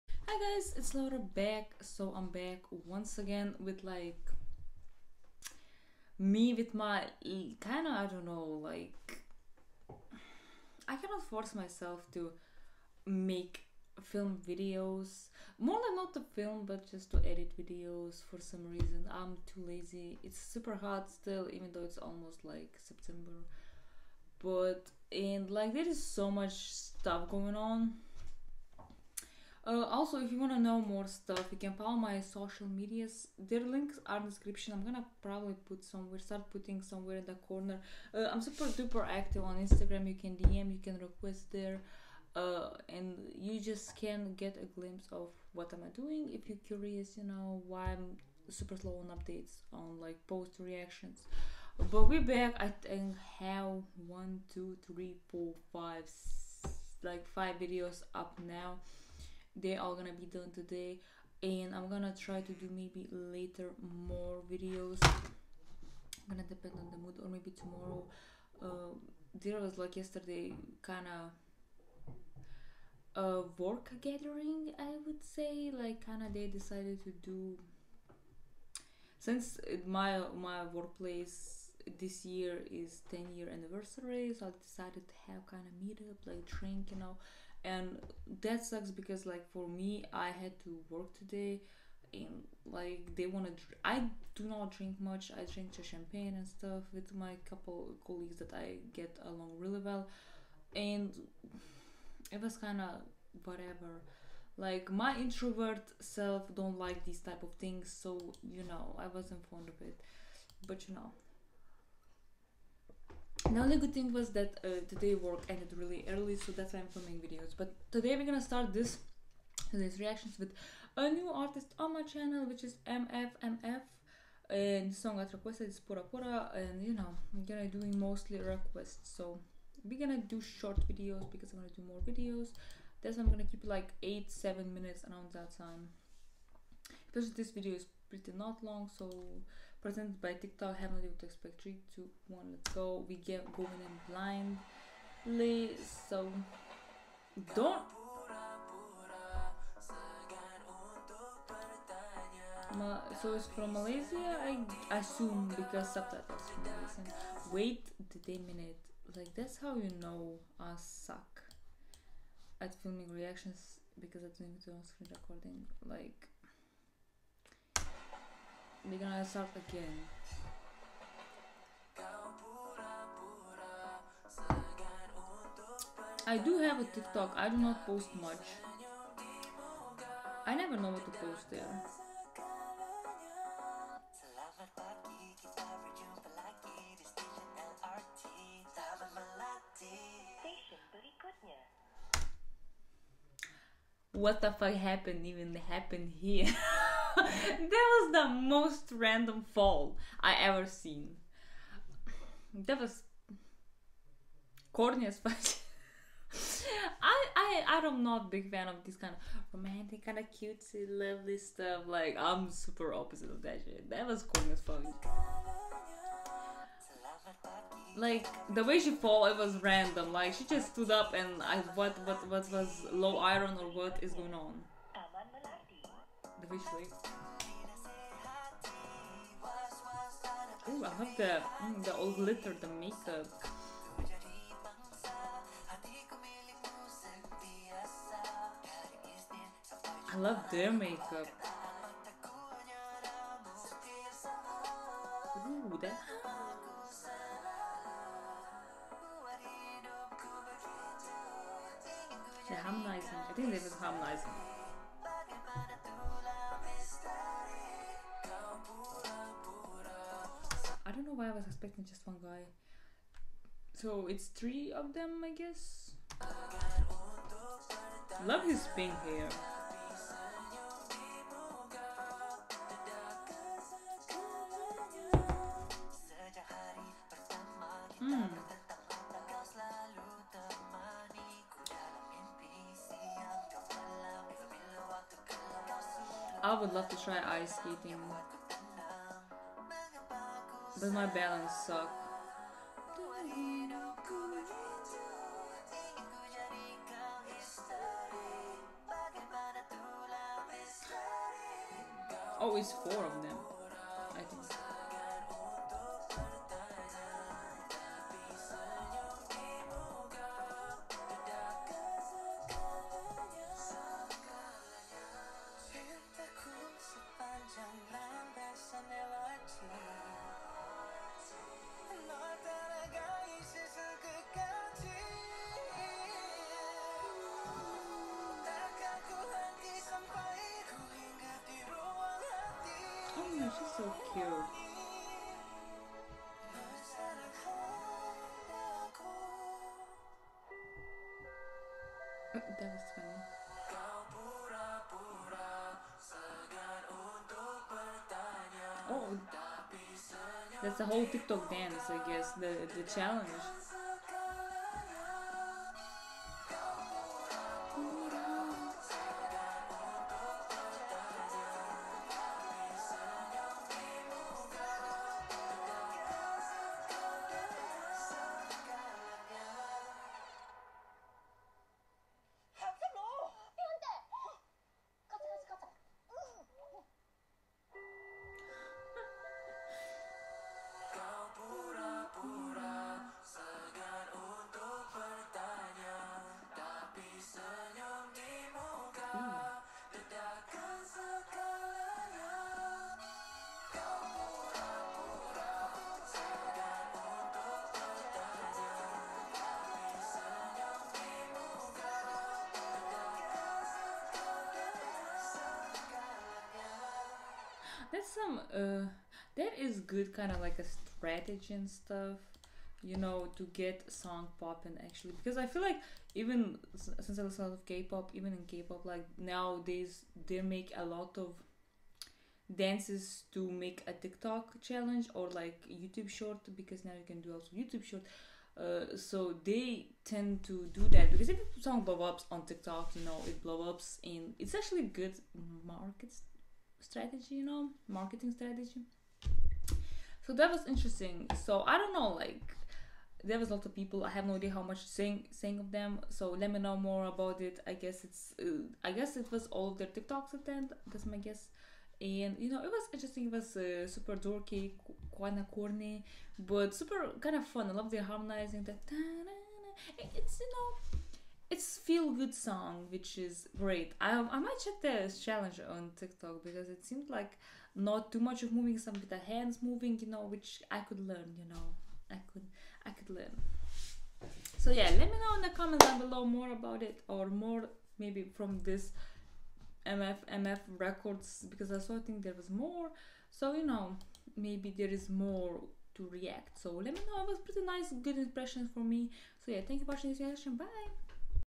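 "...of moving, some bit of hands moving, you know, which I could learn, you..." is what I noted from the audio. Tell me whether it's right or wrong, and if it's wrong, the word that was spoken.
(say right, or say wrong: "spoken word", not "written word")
right.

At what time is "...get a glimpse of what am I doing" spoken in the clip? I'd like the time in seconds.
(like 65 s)
44 s.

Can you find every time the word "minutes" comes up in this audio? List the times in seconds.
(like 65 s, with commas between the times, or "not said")
134 s, 158 s.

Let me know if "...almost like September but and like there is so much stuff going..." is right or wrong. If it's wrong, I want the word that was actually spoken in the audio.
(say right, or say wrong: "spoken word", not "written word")
right.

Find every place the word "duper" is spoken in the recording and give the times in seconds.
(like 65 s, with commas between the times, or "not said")
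38 s.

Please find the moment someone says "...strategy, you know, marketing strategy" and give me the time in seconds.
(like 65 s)
436 s.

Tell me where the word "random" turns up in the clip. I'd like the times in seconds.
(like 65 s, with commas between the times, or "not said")
198 s, 219 s.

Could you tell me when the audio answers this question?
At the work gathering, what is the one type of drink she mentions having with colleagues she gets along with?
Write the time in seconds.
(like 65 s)
95 s.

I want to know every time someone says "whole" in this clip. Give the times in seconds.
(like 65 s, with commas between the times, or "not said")
350 s.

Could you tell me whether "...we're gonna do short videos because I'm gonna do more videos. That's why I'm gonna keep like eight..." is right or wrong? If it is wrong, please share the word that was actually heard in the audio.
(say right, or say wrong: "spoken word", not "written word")
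right.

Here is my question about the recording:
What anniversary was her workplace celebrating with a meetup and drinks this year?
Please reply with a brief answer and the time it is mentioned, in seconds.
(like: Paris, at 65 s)
10 year, at 83 s.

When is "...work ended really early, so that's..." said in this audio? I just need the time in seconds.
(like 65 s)
115 s.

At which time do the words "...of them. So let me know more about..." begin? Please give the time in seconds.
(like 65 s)
445 s.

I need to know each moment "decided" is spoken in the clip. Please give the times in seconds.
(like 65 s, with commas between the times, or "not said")
76 s, 84 s.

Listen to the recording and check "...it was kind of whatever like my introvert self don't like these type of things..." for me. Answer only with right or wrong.
right.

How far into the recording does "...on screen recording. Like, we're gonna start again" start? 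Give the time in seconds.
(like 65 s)
164 s.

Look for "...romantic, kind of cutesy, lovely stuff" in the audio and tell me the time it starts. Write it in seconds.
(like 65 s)
209 s.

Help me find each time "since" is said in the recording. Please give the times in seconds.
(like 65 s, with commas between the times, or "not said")
79 s, 416 s.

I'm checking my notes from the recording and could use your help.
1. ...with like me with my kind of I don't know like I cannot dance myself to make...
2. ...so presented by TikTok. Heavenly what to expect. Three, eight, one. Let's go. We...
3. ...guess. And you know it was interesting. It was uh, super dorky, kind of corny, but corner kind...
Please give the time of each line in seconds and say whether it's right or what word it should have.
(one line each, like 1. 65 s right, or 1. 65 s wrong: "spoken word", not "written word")
1. 3 s wrong: "force", not "dance"
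2. 138 s wrong: "two", not "eight"
3. 451 s wrong: "super", not "corner".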